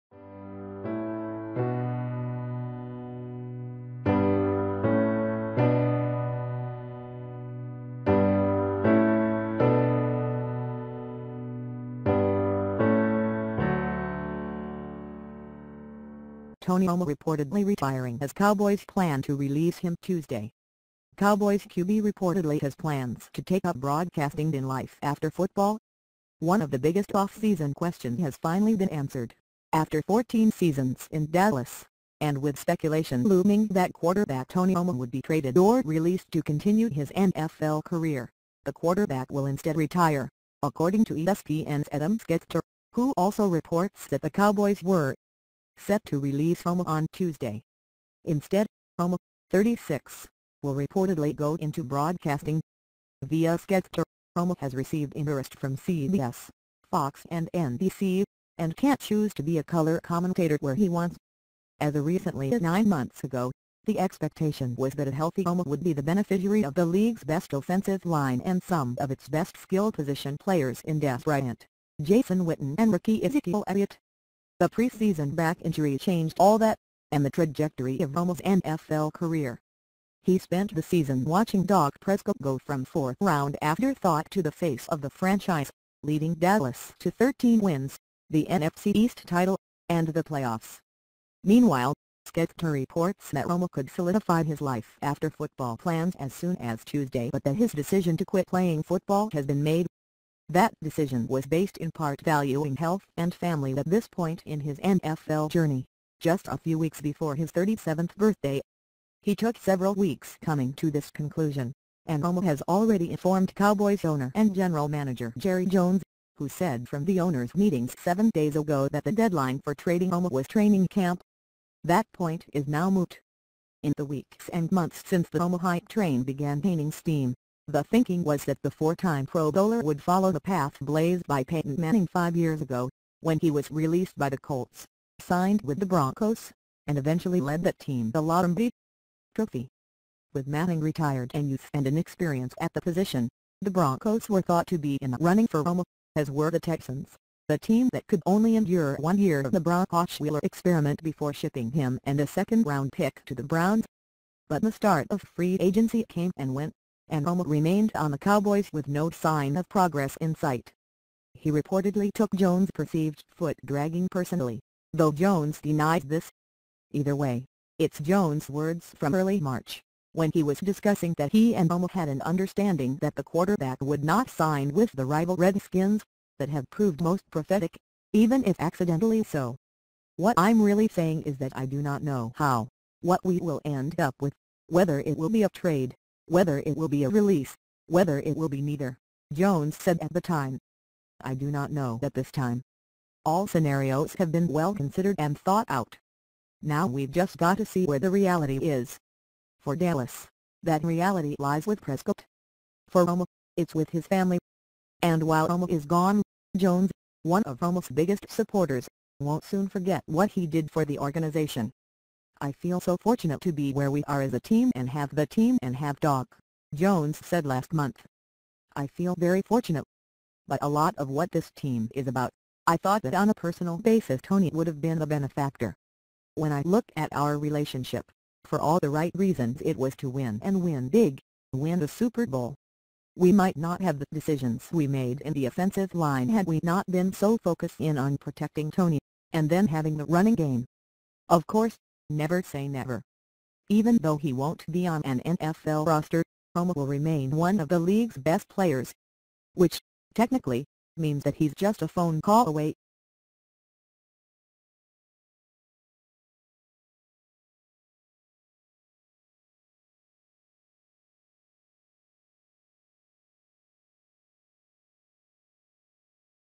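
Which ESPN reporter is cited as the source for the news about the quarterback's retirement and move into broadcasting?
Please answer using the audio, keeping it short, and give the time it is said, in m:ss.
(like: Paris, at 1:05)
Adam Schefter, at 0:41.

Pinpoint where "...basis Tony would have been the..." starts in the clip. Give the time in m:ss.
3:43.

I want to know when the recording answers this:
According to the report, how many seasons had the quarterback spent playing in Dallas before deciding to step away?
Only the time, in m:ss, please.
0:30.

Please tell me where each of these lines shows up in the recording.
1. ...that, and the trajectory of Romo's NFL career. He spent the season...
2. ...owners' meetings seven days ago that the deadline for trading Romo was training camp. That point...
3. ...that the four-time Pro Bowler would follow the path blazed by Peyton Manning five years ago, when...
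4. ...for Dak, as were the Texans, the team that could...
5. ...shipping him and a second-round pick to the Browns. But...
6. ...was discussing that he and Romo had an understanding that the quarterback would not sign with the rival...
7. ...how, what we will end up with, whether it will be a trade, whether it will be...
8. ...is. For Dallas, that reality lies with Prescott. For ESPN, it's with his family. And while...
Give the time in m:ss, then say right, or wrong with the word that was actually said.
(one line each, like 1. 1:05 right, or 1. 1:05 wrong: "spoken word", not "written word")
1. 1:16 right
2. 1:57 right
3. 2:08 right
4. 2:25 wrong: "Romo", not "Dak"
5. 2:31 right
6. 2:50 right
7. 3:02 right
8. 3:18 wrong: "Romo", not "ESPN".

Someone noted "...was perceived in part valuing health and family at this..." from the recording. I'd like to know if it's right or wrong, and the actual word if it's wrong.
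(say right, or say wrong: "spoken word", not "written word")
wrong: "based", not "perceived".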